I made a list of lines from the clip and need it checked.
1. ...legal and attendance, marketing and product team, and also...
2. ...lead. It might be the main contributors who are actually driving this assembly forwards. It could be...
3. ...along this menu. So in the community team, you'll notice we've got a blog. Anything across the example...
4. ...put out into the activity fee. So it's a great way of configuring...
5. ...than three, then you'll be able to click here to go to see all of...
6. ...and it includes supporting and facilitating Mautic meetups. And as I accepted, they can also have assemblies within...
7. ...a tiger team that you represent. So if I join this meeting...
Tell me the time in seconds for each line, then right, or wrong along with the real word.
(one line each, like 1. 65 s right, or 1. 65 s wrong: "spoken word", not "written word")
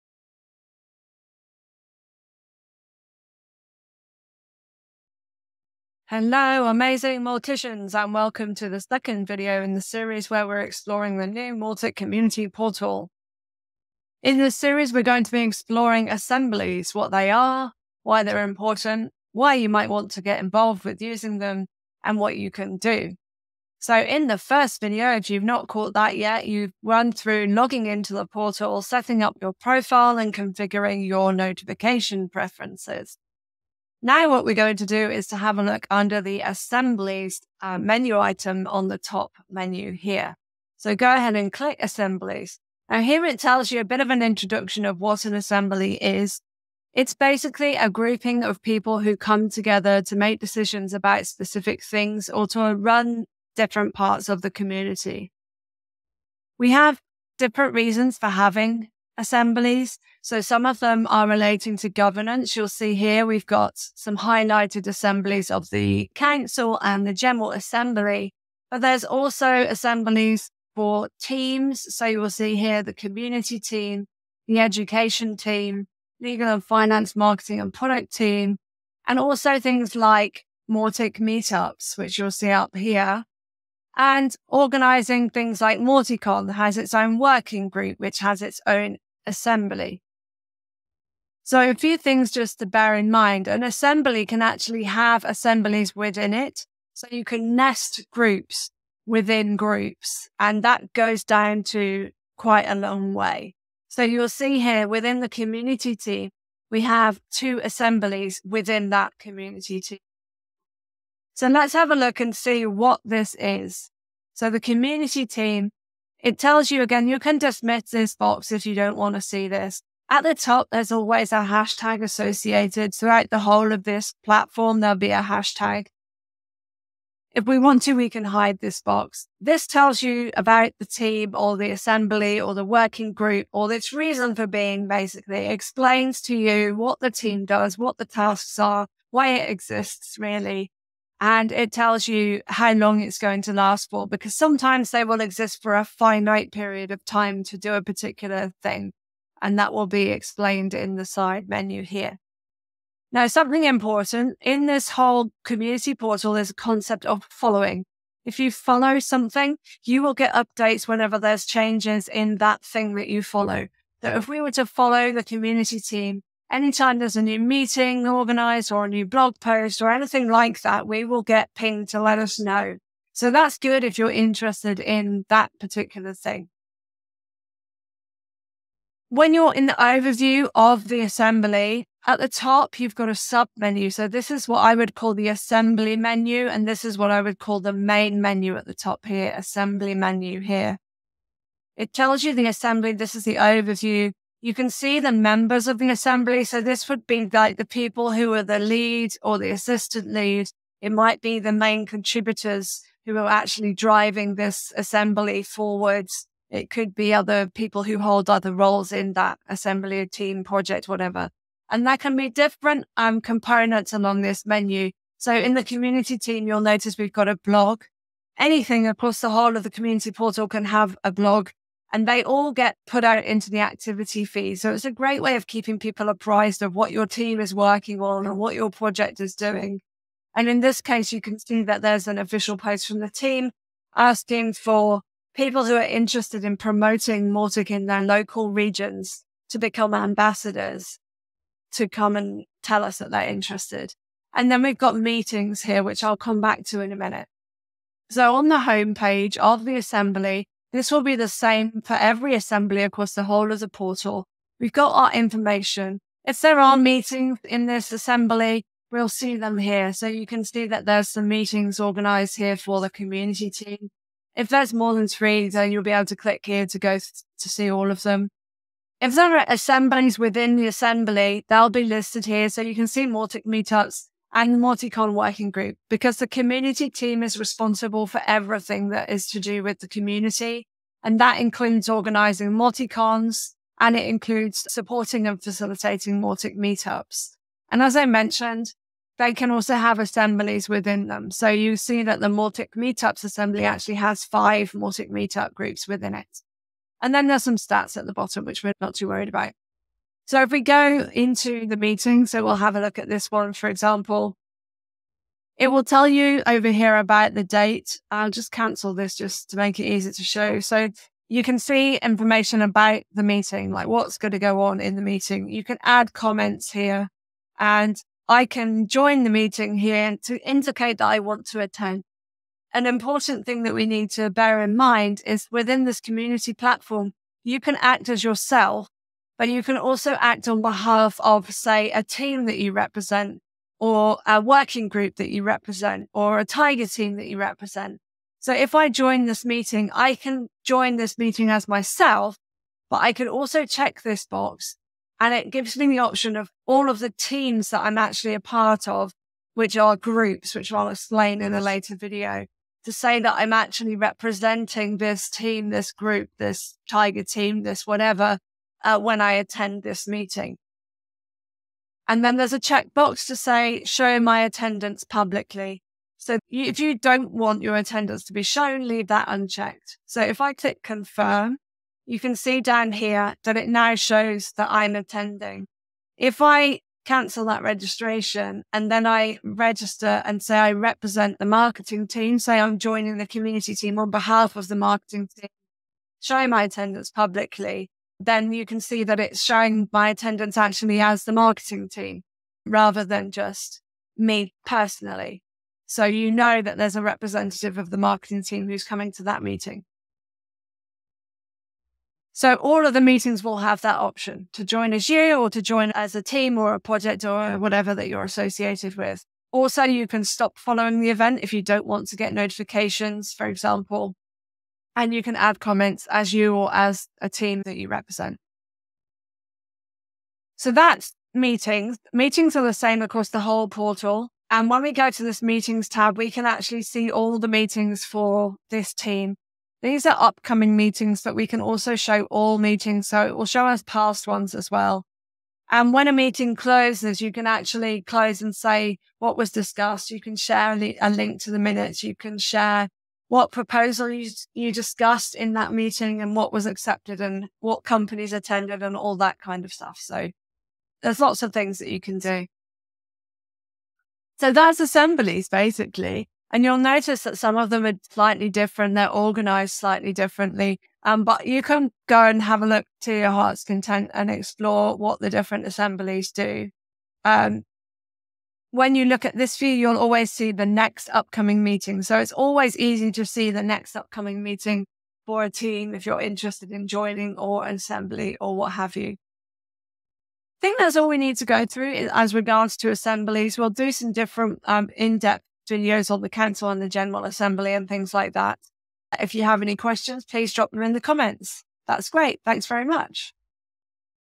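1. 76 s wrong: "finance", not "attendance"
2. 200 s right
3. 213 s wrong: "whole", not "example"
4. 222 s wrong: "keeping", not "configuring"
5. 264 s right
6. 283 s wrong: "mentioned", not "accepted"
7. 336 s right.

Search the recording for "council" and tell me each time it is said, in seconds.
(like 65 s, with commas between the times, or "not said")
66 s, 486 s.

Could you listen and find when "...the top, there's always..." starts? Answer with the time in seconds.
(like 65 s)
120 s.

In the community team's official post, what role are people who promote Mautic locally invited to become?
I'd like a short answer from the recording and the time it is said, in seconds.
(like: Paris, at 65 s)
Ambassadors, at 239 s.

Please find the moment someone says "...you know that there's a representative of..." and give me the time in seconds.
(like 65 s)
396 s.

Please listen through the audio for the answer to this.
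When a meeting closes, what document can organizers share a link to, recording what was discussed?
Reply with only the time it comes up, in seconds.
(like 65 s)
441 s.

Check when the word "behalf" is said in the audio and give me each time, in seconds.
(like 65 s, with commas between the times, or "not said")
330 s, 384 s.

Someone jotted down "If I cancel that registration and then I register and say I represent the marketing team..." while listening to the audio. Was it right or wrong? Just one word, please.
right.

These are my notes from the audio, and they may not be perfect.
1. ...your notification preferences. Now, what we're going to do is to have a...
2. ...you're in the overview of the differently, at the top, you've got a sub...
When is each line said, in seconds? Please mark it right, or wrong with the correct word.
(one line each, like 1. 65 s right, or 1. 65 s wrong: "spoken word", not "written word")
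1. 31 s right
2. 179 s wrong: "assembly", not "differently".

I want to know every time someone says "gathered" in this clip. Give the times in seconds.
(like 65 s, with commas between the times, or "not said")
not said.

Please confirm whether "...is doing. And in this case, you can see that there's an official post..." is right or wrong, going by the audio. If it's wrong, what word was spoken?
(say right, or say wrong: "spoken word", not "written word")
right.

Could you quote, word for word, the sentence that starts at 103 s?
So, you'll see here within the community team, we have two assemblies within that community team.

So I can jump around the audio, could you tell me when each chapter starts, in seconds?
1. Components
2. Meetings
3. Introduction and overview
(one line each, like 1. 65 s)
1. 215 s
2. 300 s
3. 33 s.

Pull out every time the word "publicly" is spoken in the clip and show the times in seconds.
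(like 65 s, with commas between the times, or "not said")
365 s, 387 s.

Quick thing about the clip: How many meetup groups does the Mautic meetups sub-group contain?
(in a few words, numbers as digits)
5.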